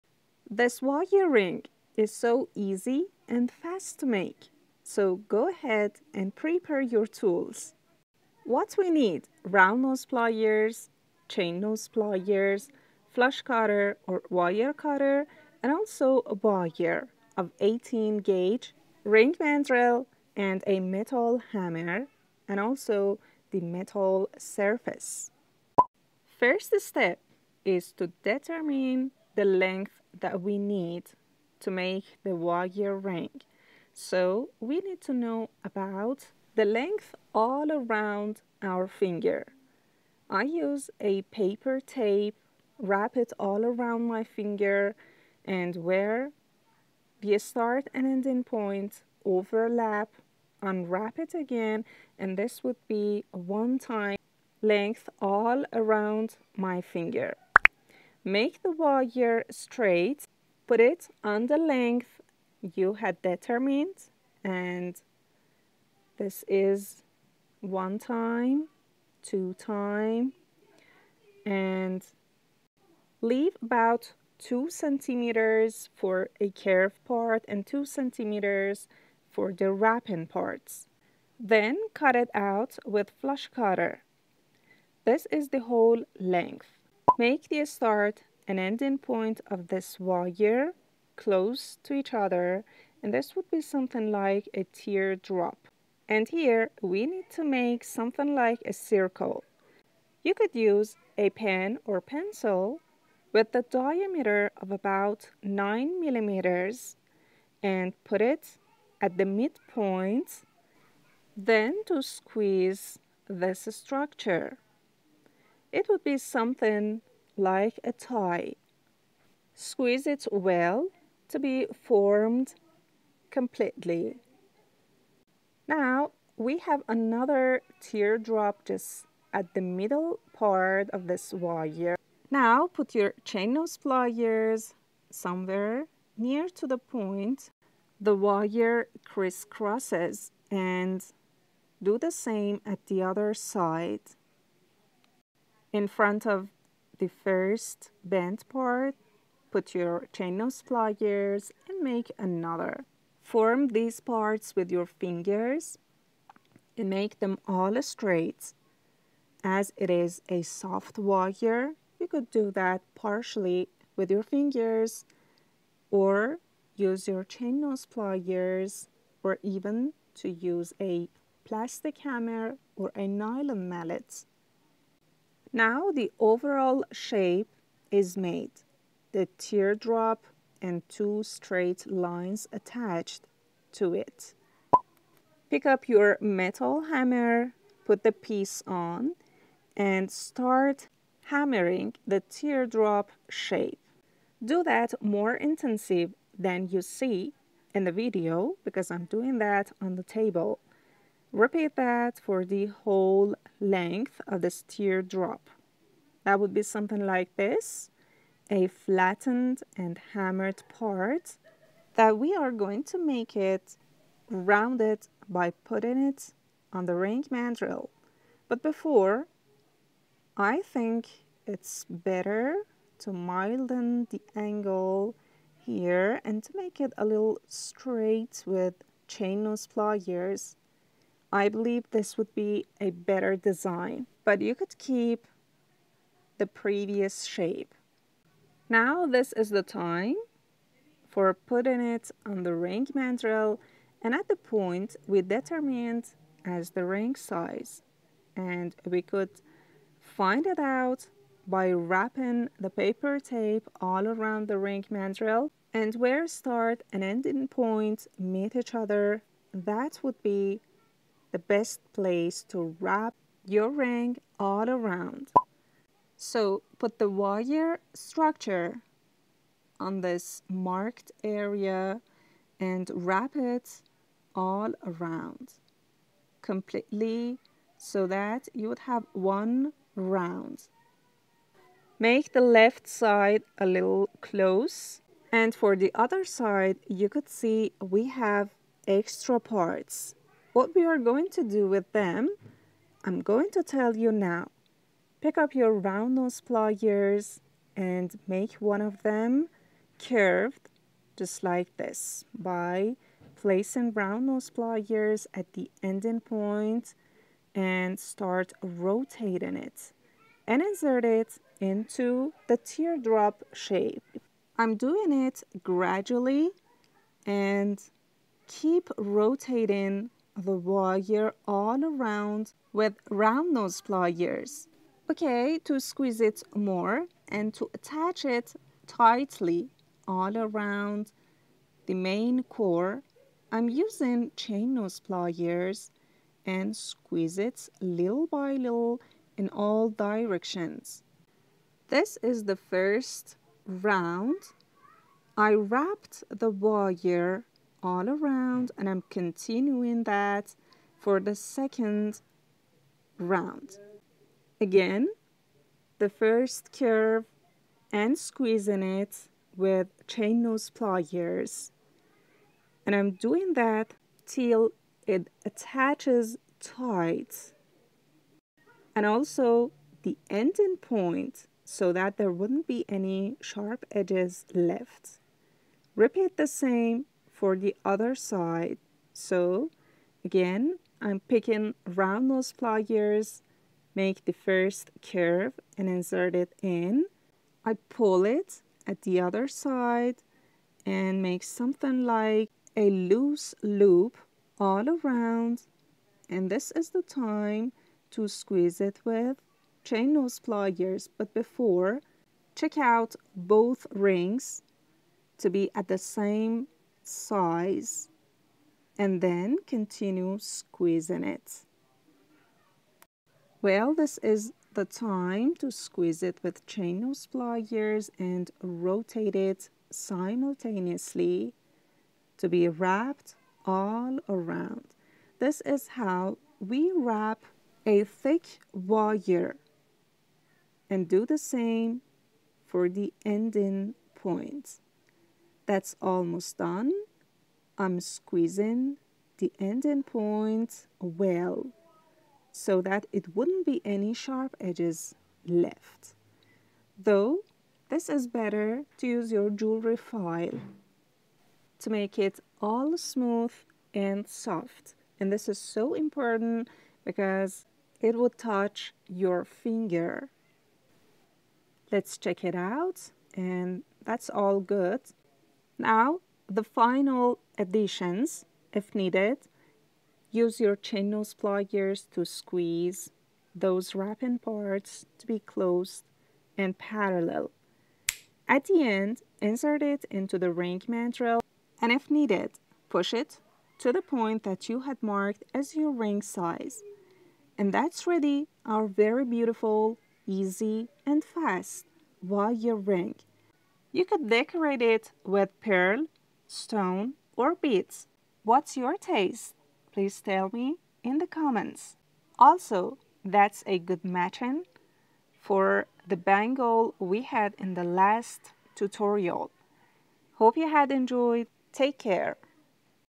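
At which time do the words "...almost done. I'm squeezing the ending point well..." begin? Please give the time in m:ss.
7:16.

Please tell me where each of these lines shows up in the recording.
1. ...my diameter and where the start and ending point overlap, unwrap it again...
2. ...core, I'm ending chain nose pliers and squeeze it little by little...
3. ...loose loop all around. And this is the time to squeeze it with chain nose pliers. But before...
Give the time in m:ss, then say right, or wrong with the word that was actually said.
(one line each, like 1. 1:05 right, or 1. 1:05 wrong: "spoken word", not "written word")
1. 0:44 wrong: "finger", not "diameter"
2. 5:32 wrong: "using", not "ending"
3. 6:32 right.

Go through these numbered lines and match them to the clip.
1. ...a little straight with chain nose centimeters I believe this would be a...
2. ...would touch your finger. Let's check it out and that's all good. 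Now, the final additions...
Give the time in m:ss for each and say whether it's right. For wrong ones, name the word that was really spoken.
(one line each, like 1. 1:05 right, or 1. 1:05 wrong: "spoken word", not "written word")
1. 3:46 wrong: "pliers", not "centimeters"
2. 7:38 right.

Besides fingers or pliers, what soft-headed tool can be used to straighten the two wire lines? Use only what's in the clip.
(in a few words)
nylon mallet.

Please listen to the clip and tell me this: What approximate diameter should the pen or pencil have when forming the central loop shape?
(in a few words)
9 millimeters.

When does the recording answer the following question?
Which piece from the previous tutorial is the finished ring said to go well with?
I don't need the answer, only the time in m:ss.
8:26.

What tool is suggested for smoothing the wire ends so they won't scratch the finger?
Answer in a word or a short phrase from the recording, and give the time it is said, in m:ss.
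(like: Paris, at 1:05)
jewelry file, at 7:29.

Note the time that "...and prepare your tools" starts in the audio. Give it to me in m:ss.
0:06.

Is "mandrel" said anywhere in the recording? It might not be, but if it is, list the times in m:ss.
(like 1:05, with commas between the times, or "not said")
0:19, 3:37, 4:02, 4:14, 8:00.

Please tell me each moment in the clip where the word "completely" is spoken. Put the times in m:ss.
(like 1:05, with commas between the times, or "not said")
2:03, 4:36.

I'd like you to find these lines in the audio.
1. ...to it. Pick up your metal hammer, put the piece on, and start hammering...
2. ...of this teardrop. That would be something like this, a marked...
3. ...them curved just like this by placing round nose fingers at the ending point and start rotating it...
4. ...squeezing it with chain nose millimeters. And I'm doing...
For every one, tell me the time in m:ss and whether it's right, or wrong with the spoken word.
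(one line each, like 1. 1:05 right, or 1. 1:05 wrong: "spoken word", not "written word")
1. 3:03 right
2. 3:24 wrong: "flattened", not "marked"
3. 4:59 wrong: "pliers", not "fingers"
4. 5:58 wrong: "pliers", not "millimeters".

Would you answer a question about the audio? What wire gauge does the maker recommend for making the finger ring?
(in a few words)
18 gauge.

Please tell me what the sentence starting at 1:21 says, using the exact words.
Then cut it out with flush cutter.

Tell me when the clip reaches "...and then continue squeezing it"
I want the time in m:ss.
6:48.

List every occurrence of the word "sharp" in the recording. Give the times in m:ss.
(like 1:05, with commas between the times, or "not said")
6:13, 7:24.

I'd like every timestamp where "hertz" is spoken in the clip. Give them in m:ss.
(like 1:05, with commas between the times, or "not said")
not said.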